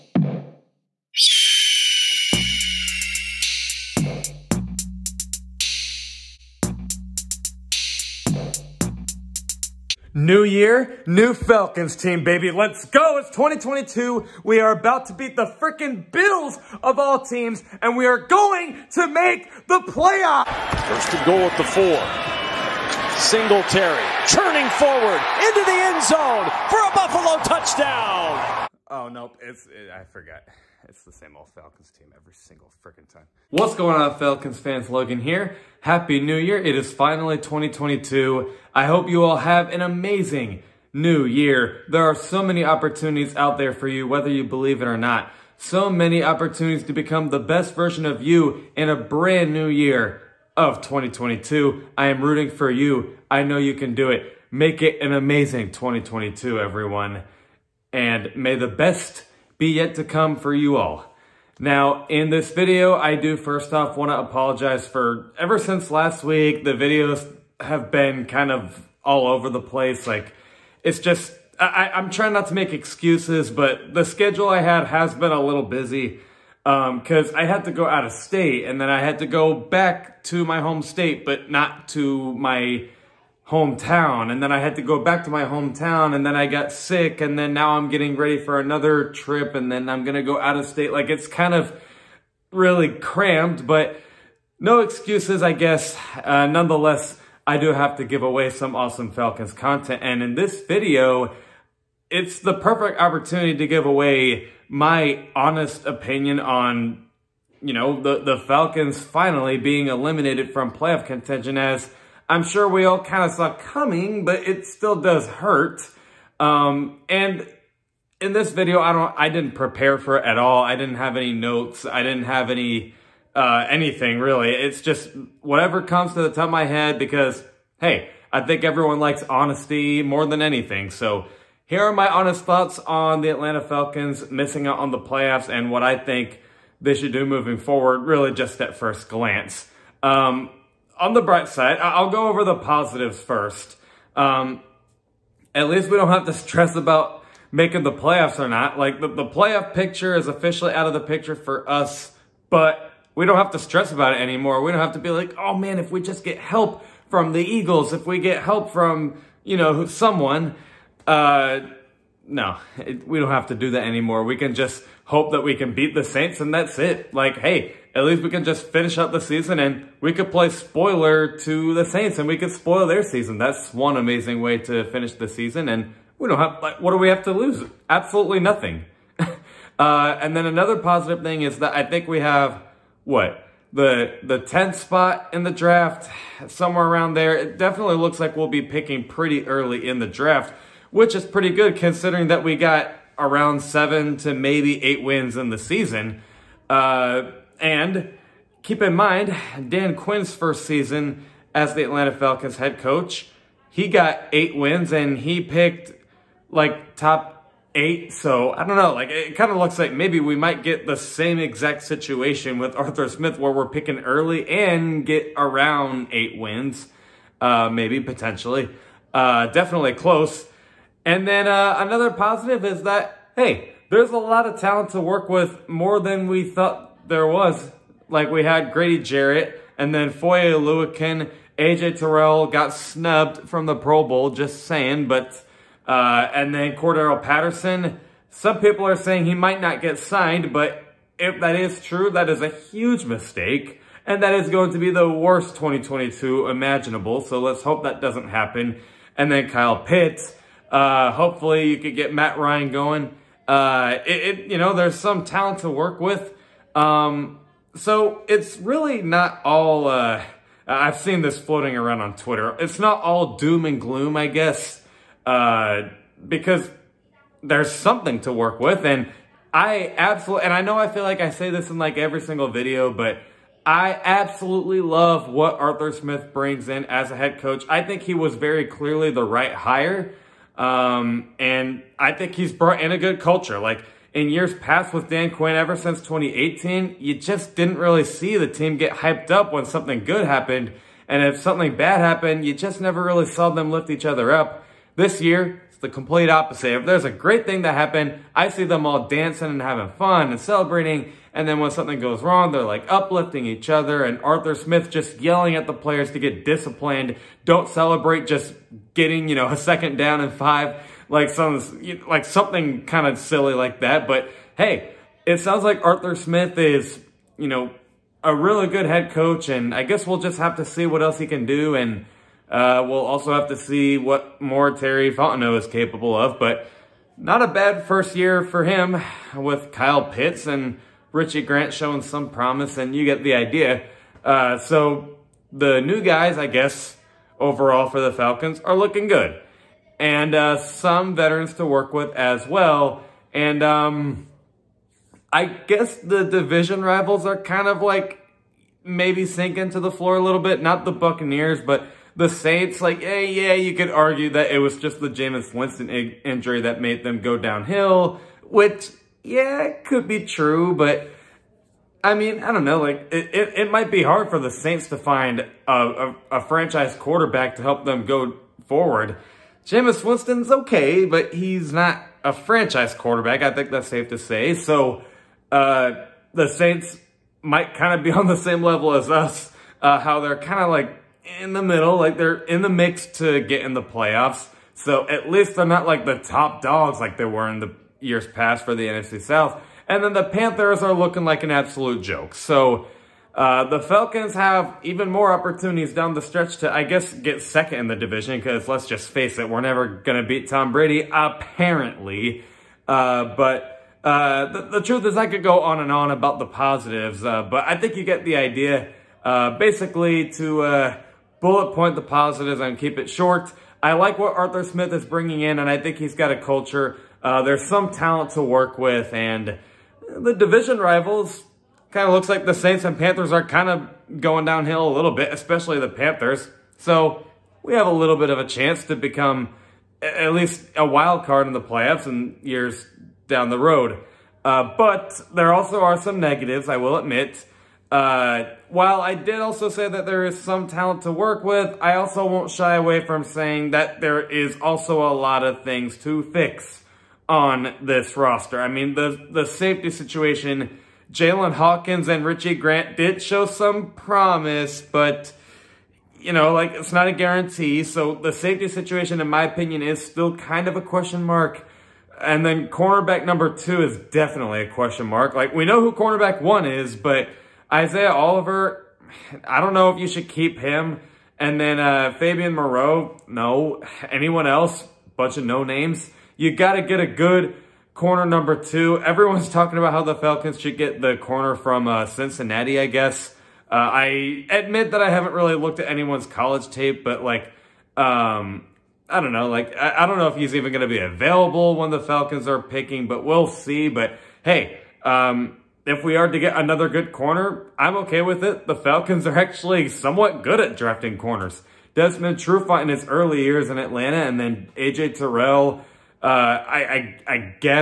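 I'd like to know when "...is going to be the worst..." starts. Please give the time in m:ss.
4:04.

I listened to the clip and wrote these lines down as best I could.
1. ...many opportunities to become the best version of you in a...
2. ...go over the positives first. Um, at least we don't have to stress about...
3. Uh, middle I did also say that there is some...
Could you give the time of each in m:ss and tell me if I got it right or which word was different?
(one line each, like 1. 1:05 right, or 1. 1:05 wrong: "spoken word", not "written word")
1. 0:45 right
2. 2:22 right
3. 7:17 wrong: "while", not "middle".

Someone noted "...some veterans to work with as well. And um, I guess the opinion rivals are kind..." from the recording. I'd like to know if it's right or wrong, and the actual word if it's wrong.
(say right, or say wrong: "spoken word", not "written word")
wrong: "division", not "opinion".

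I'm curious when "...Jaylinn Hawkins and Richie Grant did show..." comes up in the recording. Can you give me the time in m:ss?
7:31.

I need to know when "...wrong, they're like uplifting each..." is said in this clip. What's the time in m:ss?
5:02.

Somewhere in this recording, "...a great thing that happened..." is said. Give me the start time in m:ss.
4:57.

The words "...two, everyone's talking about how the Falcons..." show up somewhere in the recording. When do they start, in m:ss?
7:58.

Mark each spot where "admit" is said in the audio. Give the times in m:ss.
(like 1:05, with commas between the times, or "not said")
7:16, 8:04.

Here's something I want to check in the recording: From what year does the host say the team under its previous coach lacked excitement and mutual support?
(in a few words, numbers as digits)
2018.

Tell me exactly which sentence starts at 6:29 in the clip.
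And then the Panthers are looking like an absolute joke.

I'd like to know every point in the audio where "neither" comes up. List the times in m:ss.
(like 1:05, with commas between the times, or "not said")
not said.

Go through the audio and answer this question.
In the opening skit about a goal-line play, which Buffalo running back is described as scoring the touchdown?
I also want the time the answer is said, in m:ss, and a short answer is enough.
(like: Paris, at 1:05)
Singletary, at 0:23.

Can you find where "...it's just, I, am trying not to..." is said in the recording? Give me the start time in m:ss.
1:10.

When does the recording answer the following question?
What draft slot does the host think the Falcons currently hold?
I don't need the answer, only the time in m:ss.
3:04.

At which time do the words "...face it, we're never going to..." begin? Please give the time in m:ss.
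6:39.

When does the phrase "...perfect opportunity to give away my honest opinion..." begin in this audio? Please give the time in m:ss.
1:42.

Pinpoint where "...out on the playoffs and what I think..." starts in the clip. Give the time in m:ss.
2:14.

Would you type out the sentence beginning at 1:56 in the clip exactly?
Um, and in this video, I don't, I didn't prepare for it at all.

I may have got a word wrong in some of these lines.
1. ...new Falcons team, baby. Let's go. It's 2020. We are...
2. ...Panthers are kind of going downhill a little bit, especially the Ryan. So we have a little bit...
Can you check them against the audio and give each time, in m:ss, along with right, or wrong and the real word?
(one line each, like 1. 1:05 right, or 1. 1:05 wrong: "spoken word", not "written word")
1. 0:11 wrong: "2022", not "2020"
2. 7:02 wrong: "Panthers", not "Ryan".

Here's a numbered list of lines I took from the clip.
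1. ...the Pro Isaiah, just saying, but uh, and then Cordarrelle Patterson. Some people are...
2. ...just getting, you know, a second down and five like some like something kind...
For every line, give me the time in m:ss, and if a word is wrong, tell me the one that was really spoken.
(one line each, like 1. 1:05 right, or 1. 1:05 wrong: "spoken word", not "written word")
1. 3:53 wrong: "Bowl", not "Isaiah"
2. 5:08 right.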